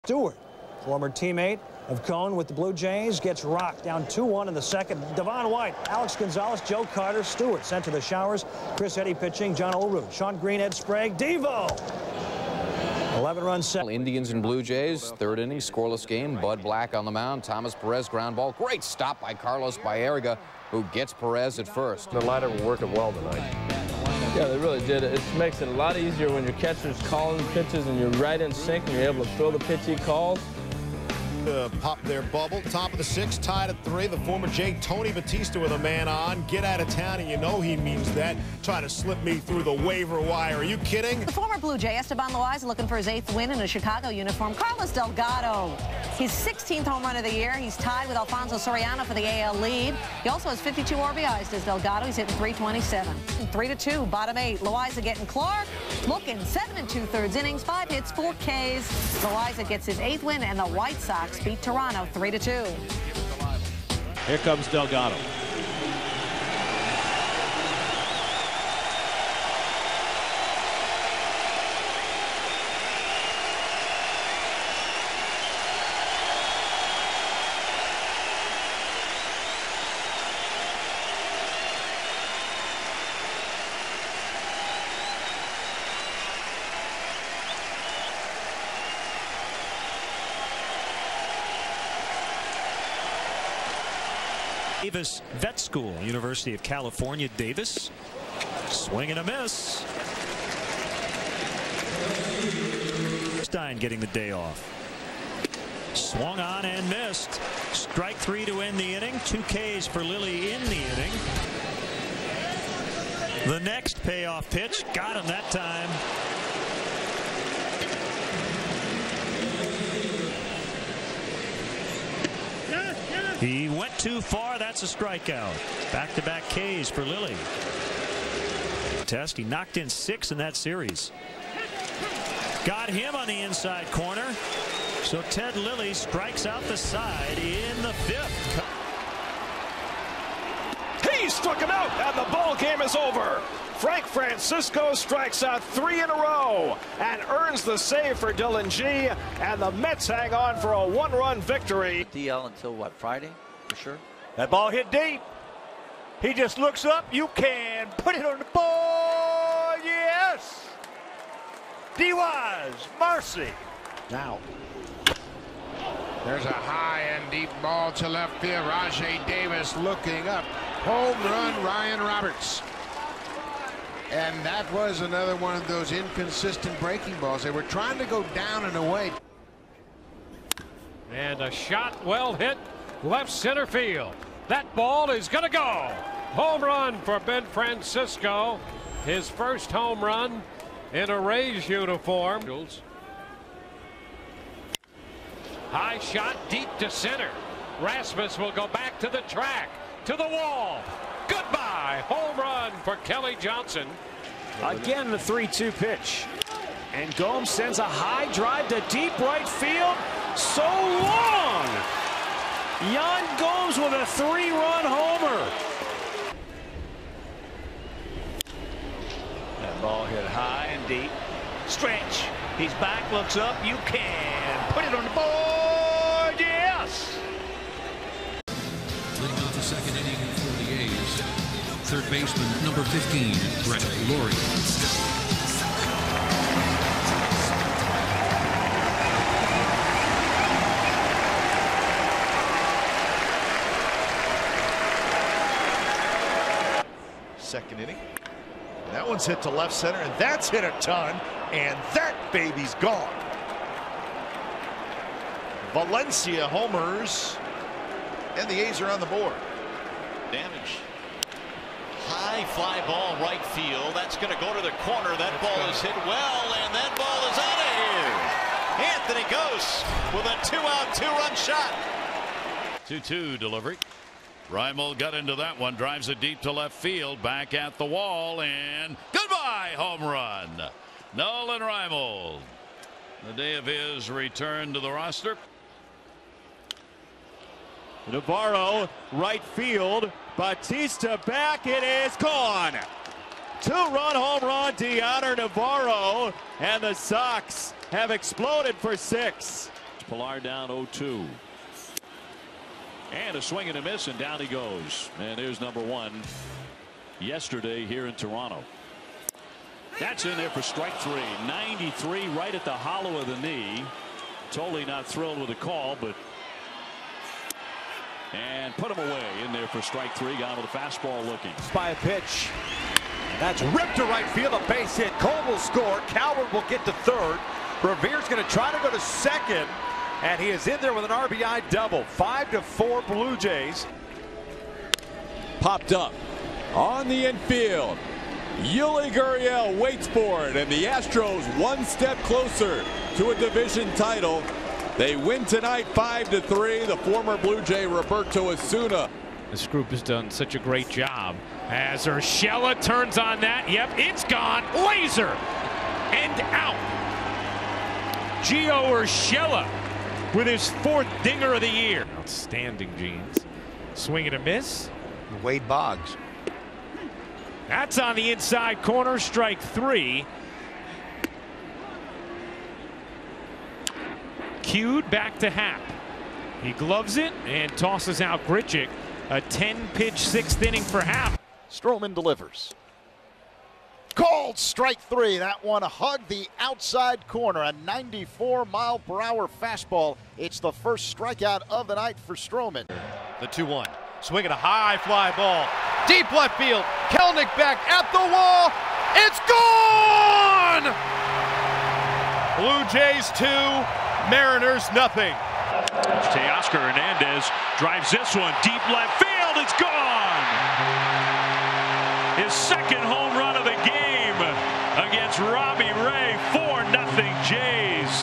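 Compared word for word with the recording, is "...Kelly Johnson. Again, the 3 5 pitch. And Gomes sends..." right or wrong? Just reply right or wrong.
wrong.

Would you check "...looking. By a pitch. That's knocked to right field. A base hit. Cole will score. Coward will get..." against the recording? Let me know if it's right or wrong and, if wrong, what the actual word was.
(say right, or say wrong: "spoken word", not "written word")
wrong: "ripped", not "knocked".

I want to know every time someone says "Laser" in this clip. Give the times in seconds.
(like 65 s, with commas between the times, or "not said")
354 s.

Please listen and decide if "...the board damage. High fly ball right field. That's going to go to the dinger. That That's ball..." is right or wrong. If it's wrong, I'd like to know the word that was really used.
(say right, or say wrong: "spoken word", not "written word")
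wrong: "corner", not "dinger".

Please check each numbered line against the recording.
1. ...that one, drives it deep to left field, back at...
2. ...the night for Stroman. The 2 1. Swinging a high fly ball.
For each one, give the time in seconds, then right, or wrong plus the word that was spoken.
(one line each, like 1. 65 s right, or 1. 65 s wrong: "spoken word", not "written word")
1. 275 s right
2. 391 s right.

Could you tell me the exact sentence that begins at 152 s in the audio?
DL until what, Friday, for sure?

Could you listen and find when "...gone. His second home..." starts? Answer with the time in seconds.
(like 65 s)
409 s.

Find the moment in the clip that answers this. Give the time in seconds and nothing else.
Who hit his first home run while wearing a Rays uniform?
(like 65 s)
187 s.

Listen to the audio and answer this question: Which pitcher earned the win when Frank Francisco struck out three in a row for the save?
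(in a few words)
Dillon Gee.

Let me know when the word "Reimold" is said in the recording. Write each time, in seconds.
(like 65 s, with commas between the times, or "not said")
274 s, 281 s.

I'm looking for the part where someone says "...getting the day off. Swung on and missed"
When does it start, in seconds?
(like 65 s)
103 s.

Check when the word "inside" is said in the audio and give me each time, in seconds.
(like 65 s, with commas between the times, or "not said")
133 s, 368 s.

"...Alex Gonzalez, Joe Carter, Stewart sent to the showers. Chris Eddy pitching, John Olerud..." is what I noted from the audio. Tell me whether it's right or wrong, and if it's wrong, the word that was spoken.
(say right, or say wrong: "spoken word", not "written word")
right.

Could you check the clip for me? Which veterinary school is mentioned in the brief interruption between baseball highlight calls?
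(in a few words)
Davis Vet School.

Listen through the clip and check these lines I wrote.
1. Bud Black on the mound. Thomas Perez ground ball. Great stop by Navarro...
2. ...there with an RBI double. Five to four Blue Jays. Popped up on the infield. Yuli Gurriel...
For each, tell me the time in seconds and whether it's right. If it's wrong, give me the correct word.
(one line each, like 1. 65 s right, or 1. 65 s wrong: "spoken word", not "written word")
1. 16 s wrong: "Carlos", not "Navarro"
2. 330 s right.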